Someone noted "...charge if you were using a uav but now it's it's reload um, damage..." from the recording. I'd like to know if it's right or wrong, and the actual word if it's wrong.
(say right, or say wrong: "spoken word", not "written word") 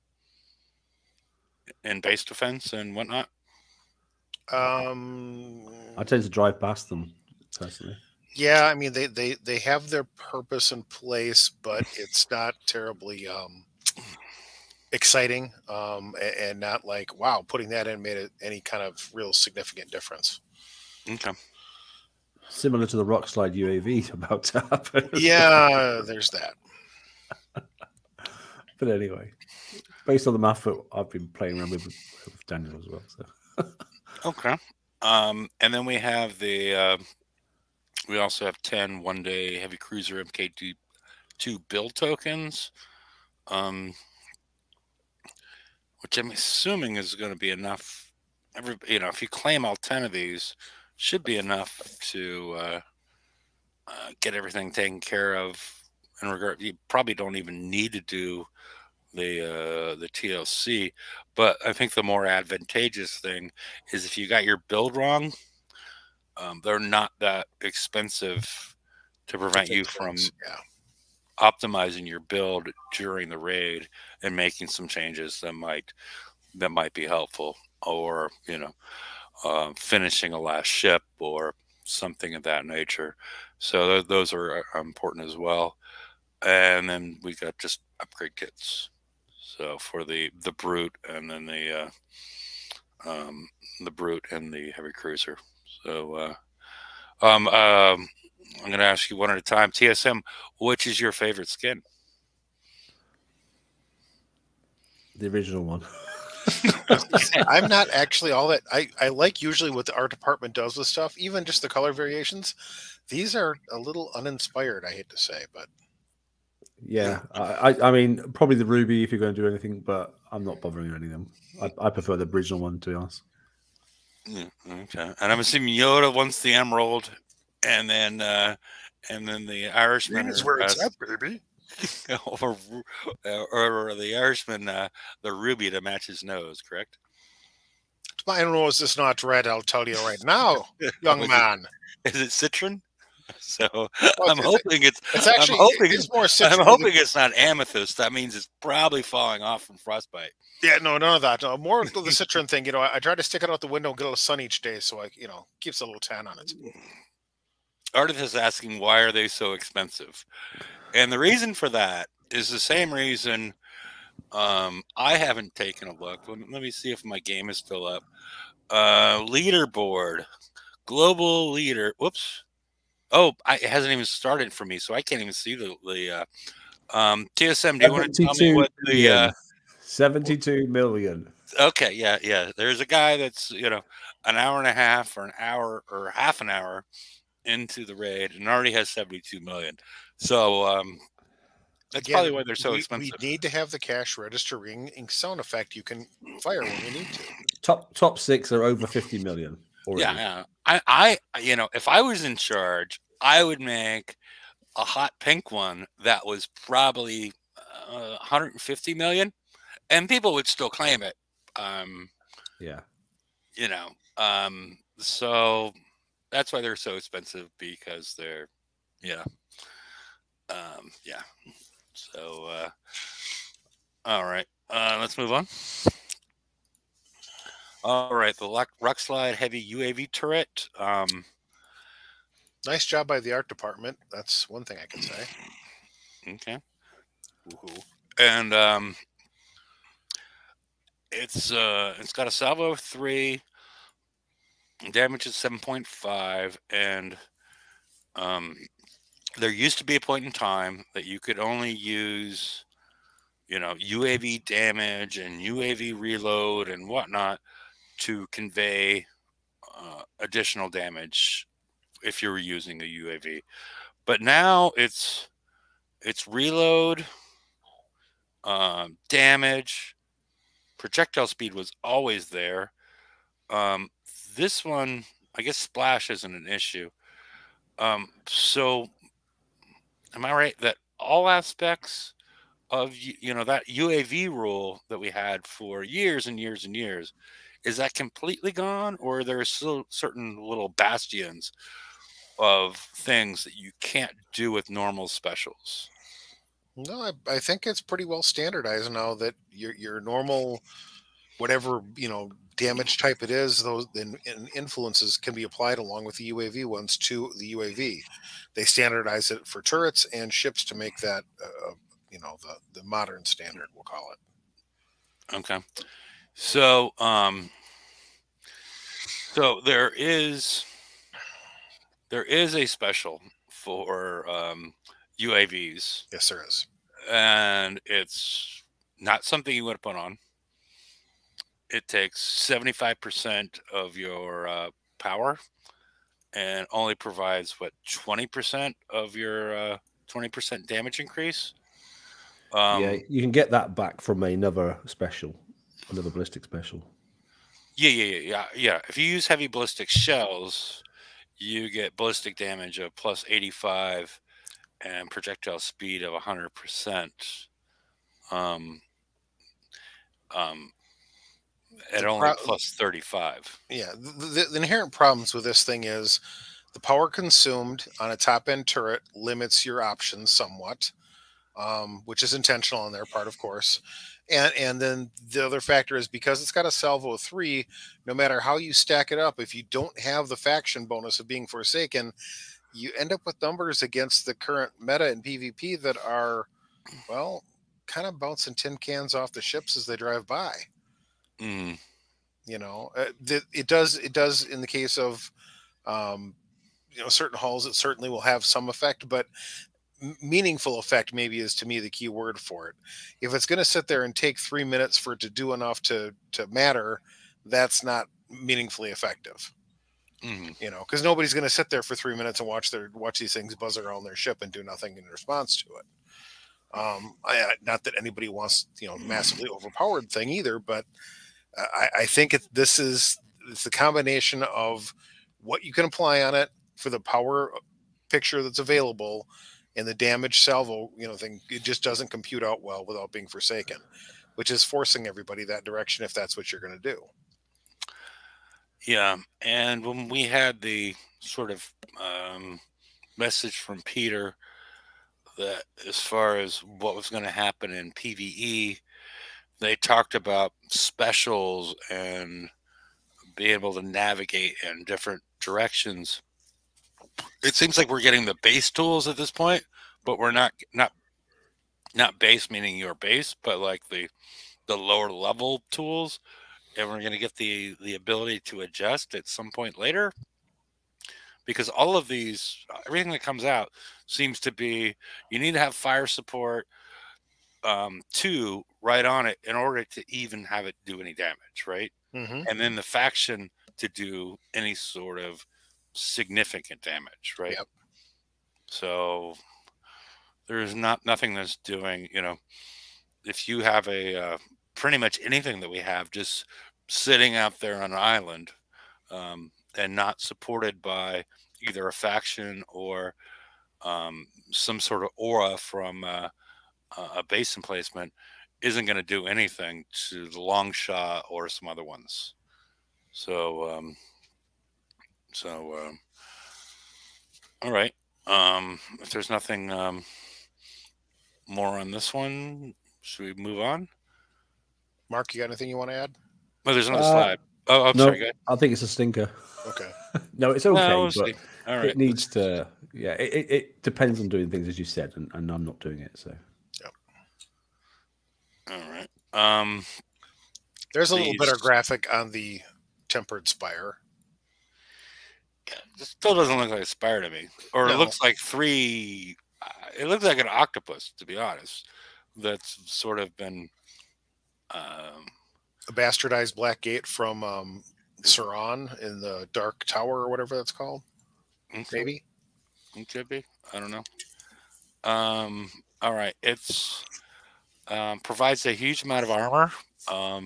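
wrong: "damage", not "charge".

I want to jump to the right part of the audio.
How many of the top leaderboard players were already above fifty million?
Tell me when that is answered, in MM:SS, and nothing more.
03:17.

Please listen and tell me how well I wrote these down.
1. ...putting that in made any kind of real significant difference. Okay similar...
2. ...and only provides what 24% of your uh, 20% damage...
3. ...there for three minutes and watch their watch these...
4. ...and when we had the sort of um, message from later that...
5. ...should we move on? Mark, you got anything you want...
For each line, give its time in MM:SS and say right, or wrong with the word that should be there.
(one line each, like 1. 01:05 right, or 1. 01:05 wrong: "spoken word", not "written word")
1. 00:17 right
2. 05:36 wrong: "20", not "24"
3. 06:51 right
4. 07:19 wrong: "peter", not "later"
5. 08:43 right.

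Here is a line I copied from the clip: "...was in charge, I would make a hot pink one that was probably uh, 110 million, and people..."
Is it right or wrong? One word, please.
wrong.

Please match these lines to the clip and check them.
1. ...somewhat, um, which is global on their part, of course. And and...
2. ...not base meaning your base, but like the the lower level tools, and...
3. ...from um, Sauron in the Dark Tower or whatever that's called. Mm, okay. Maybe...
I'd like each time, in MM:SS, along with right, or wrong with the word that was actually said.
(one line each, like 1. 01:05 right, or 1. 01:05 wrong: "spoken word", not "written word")
1. 06:10 wrong: "intentional", not "global"
2. 07:41 right
3. 09:17 right.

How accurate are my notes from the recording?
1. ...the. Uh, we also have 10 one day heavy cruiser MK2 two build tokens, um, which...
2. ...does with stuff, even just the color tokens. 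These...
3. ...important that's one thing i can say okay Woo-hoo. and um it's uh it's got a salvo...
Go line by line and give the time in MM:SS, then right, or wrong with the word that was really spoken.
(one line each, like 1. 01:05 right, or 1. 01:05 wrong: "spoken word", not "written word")
1. 00:36 right
2. 01:50 wrong: "variations", not "tokens"
3. 03:53 wrong: "department", not "important".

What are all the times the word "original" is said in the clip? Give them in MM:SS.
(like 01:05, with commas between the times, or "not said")
01:45, 02:02.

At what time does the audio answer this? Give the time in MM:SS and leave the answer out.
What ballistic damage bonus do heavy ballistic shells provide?
05:52.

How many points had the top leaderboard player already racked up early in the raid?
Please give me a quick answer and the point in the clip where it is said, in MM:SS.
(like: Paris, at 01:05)
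72 million, at 03:08.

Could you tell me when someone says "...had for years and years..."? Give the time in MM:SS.
04:45.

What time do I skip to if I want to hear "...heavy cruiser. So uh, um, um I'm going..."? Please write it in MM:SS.
01:34.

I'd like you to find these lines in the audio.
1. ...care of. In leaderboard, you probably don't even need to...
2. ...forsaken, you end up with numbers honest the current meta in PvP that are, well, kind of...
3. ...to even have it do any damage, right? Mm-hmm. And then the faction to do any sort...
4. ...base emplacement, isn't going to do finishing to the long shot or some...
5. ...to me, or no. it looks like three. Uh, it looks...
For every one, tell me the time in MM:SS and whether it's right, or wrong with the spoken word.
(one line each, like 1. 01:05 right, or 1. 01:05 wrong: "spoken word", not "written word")
1. 00:54 wrong: "regard", not "leaderboard"
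2. 06:21 wrong: "against", not "honest"
3. 07:59 right
4. 08:27 wrong: "anything", not "finishing"
5. 09:07 right.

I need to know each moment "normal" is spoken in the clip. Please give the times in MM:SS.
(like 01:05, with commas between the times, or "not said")
04:54, 05:00.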